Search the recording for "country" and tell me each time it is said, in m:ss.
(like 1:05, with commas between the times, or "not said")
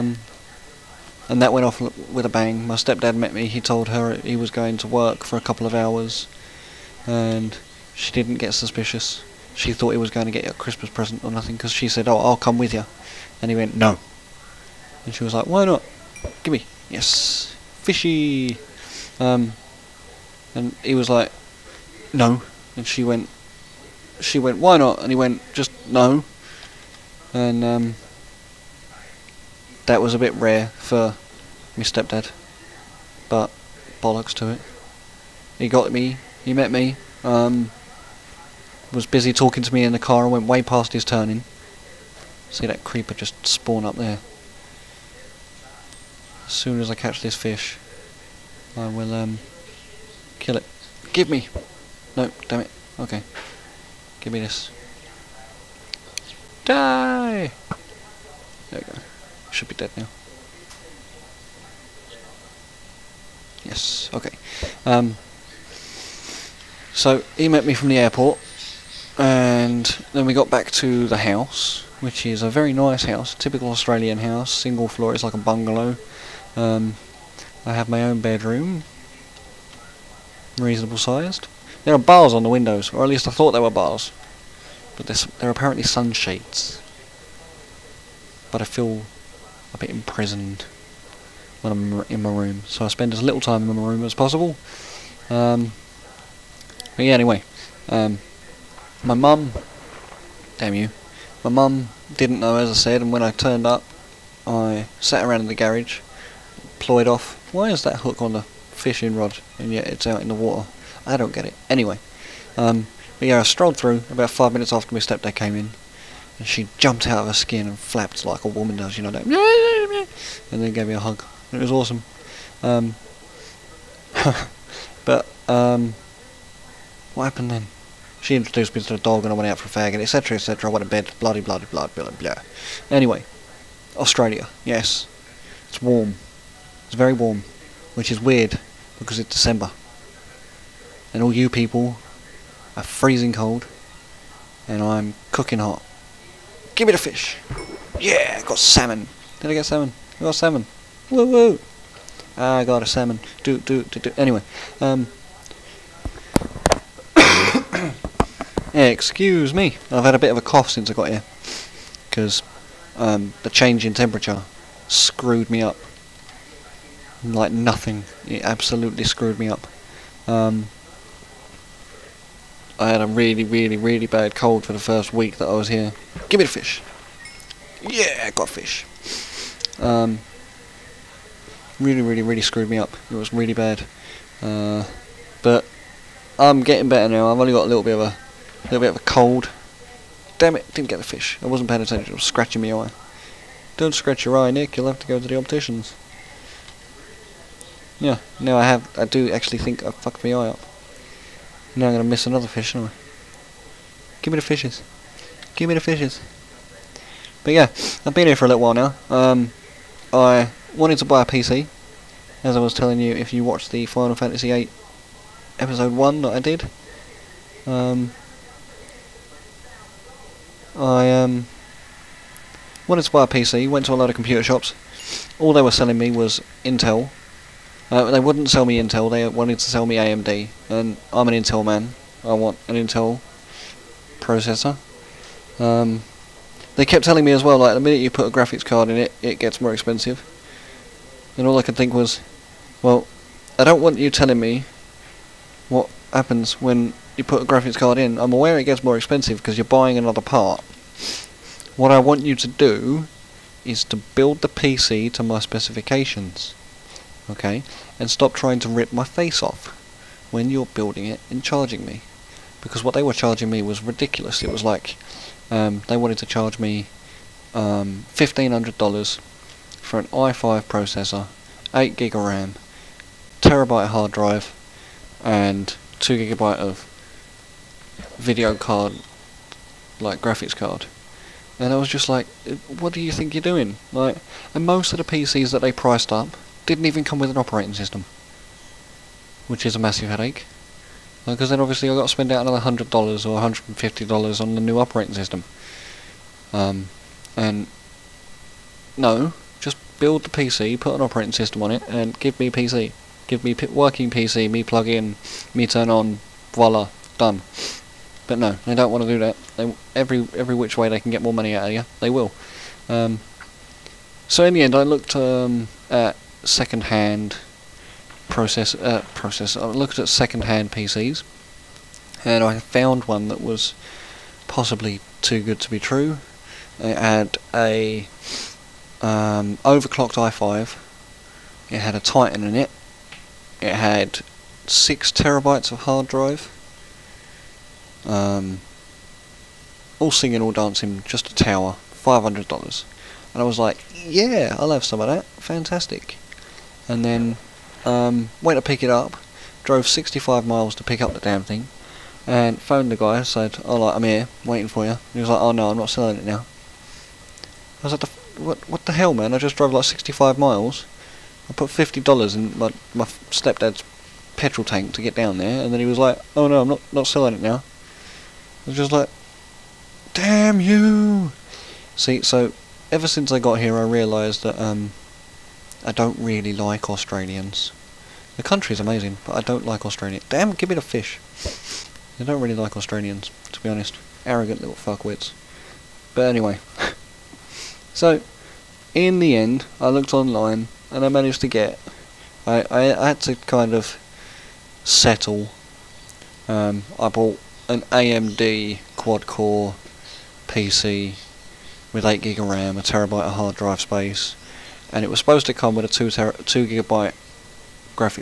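6:18.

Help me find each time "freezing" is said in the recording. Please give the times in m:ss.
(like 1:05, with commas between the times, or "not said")
2:22.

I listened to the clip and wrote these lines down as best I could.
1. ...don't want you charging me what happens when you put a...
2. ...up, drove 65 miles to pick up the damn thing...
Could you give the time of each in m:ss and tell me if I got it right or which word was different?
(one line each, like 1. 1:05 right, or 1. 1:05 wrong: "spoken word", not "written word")
1. 4:03 wrong: "telling", not "charging"
2. 5:48 right.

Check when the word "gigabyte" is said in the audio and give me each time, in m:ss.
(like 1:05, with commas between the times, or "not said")
4:36, 6:46.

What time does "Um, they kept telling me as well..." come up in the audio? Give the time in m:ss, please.
3:55.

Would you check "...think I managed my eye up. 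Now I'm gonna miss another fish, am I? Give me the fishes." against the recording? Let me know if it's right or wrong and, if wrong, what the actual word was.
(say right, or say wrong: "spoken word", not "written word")
wrong: "fucked", not "managed".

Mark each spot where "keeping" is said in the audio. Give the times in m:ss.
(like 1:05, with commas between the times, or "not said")
not said.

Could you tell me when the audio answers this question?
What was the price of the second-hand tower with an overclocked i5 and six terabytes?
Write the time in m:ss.
5:41.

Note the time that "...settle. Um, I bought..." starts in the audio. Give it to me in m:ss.
6:34.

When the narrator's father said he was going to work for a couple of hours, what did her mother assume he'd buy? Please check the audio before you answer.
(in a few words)
Christmas present.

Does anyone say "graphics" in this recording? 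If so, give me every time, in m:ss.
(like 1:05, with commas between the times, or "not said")
3:58, 4:07, 4:40.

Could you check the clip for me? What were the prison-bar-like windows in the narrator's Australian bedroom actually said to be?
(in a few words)
sunshades.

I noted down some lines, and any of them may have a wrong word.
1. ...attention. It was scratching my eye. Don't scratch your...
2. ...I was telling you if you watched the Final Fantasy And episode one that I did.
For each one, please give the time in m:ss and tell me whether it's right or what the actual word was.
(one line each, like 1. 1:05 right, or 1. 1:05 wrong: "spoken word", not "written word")
1. 3:11 right
2. 3:32 wrong: "VIII", not "And".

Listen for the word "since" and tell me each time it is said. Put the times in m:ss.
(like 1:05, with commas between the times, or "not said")
2:40, 6:13.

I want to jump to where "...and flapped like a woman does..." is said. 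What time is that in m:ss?
1:57.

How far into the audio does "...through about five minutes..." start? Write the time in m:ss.
1:53.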